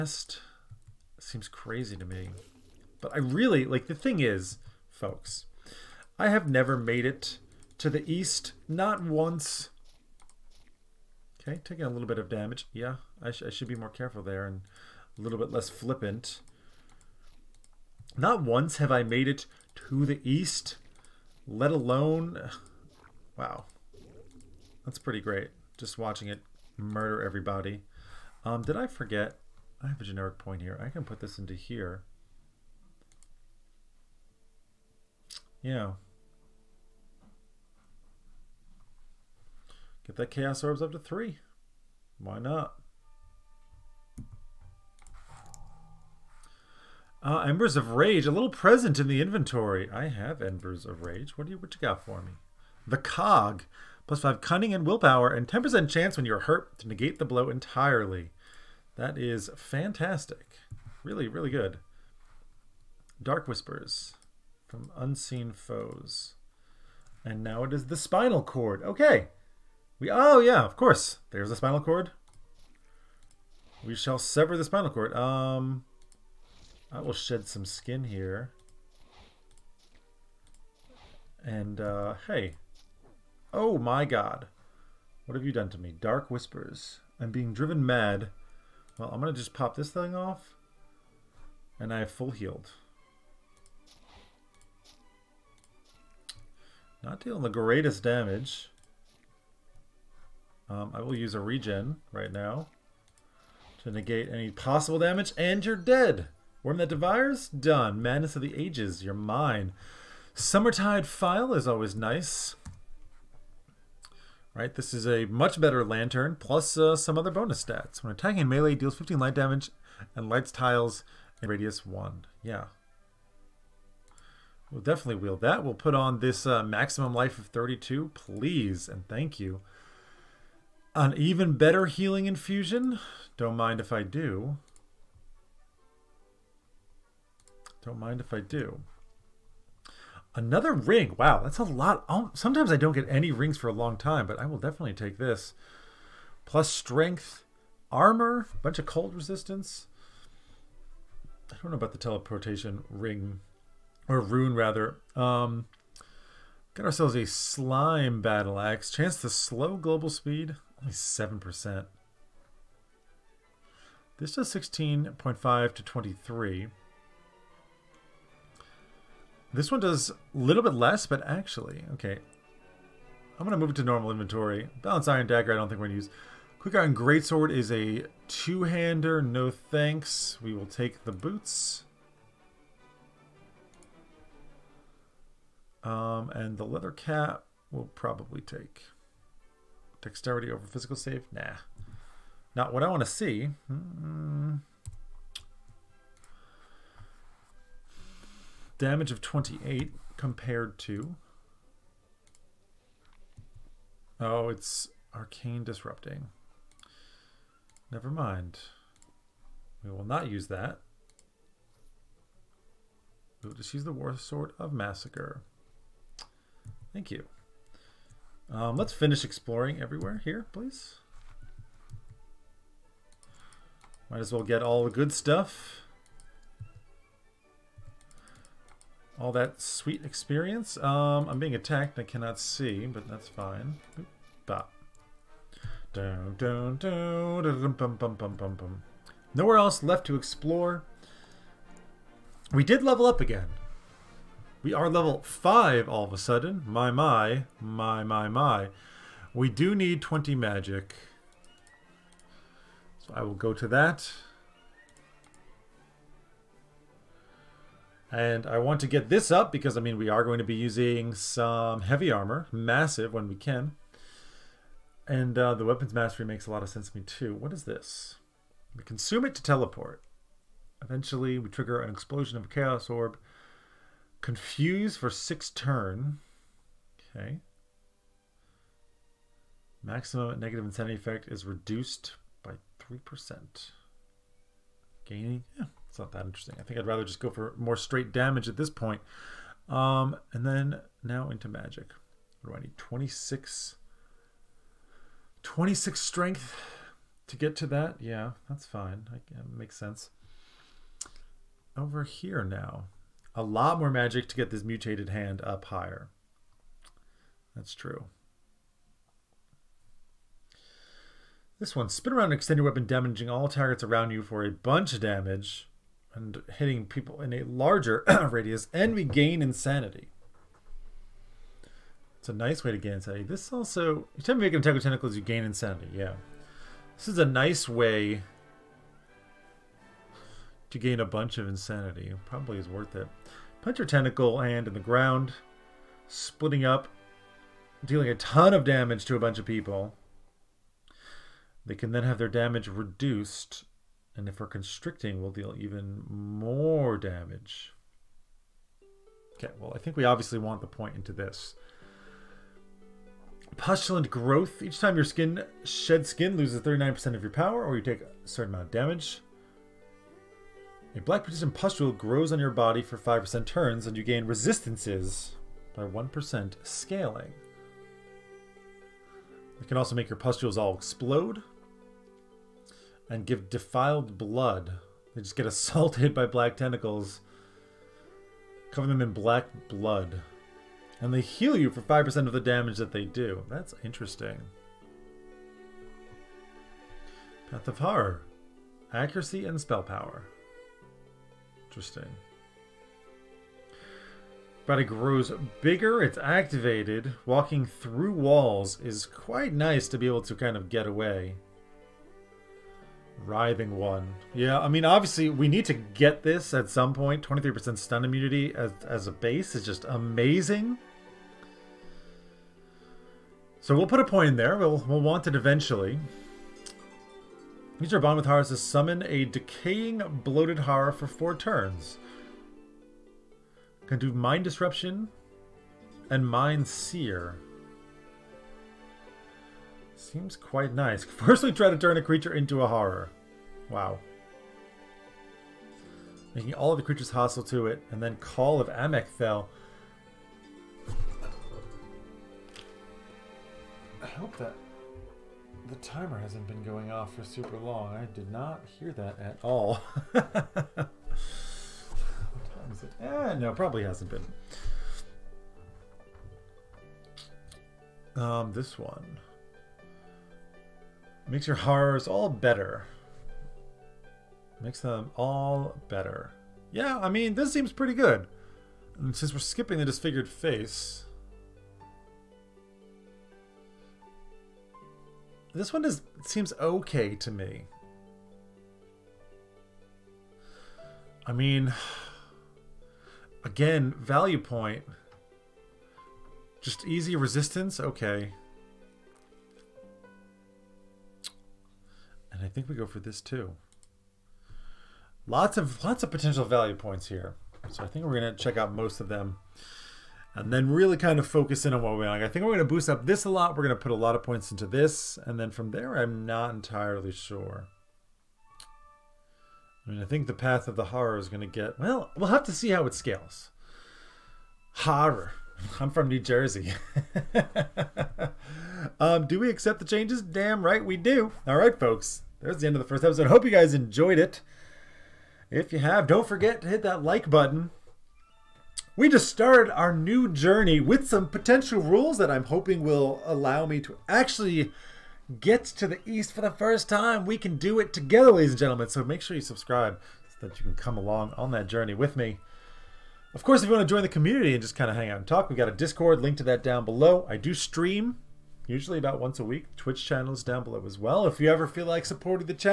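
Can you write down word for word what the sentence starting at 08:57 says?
We can do it together, ladies and gentlemen.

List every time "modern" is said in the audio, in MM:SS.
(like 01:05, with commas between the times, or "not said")
not said.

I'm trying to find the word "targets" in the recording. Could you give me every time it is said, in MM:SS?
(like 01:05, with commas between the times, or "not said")
05:13.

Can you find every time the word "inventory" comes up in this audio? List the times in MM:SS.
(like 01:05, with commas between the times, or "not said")
00:49, 02:54.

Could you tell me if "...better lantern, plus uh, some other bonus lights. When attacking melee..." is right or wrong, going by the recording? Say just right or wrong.
wrong.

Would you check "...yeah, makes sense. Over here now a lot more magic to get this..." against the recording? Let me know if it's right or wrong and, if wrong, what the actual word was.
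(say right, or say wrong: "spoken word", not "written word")
right.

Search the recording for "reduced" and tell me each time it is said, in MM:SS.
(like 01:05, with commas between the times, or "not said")
04:41, 05:42.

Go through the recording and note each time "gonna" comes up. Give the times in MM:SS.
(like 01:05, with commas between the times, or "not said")
01:29, 08:18.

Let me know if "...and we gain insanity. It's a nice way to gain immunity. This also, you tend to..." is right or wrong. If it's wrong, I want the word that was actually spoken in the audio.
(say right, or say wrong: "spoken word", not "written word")
wrong: "insanity", not "immunity".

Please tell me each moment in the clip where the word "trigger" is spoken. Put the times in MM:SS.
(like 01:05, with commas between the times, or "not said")
04:31.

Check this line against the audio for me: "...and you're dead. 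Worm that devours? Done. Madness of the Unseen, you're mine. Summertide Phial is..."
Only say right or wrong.
wrong.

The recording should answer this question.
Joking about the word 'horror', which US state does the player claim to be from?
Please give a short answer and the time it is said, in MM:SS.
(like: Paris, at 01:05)
New Jersey, at 08:36.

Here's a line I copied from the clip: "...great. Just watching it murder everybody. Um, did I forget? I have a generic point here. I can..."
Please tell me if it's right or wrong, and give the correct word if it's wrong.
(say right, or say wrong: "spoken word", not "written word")
right.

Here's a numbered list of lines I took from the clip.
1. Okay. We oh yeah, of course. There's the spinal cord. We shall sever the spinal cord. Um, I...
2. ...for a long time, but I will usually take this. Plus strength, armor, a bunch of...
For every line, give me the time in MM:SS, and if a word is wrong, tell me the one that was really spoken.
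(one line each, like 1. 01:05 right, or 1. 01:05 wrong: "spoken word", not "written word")
1. 01:08 right
2. 02:23 wrong: "definitely", not "usually".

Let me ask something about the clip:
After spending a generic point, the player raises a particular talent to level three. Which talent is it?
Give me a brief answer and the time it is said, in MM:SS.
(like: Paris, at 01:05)
Chaos Orbs, at 00:40.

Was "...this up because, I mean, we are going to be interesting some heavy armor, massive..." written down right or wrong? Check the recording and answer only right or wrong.
wrong.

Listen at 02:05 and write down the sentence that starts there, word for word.
We'll put on this uh, maximum life of 32, please, and thank you.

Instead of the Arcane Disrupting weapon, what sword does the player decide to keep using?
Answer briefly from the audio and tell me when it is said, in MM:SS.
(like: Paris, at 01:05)
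War Sword of Massacre, at 03:33.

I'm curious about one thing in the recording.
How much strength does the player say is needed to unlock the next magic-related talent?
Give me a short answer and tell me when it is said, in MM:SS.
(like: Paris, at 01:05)
26, at 04:55.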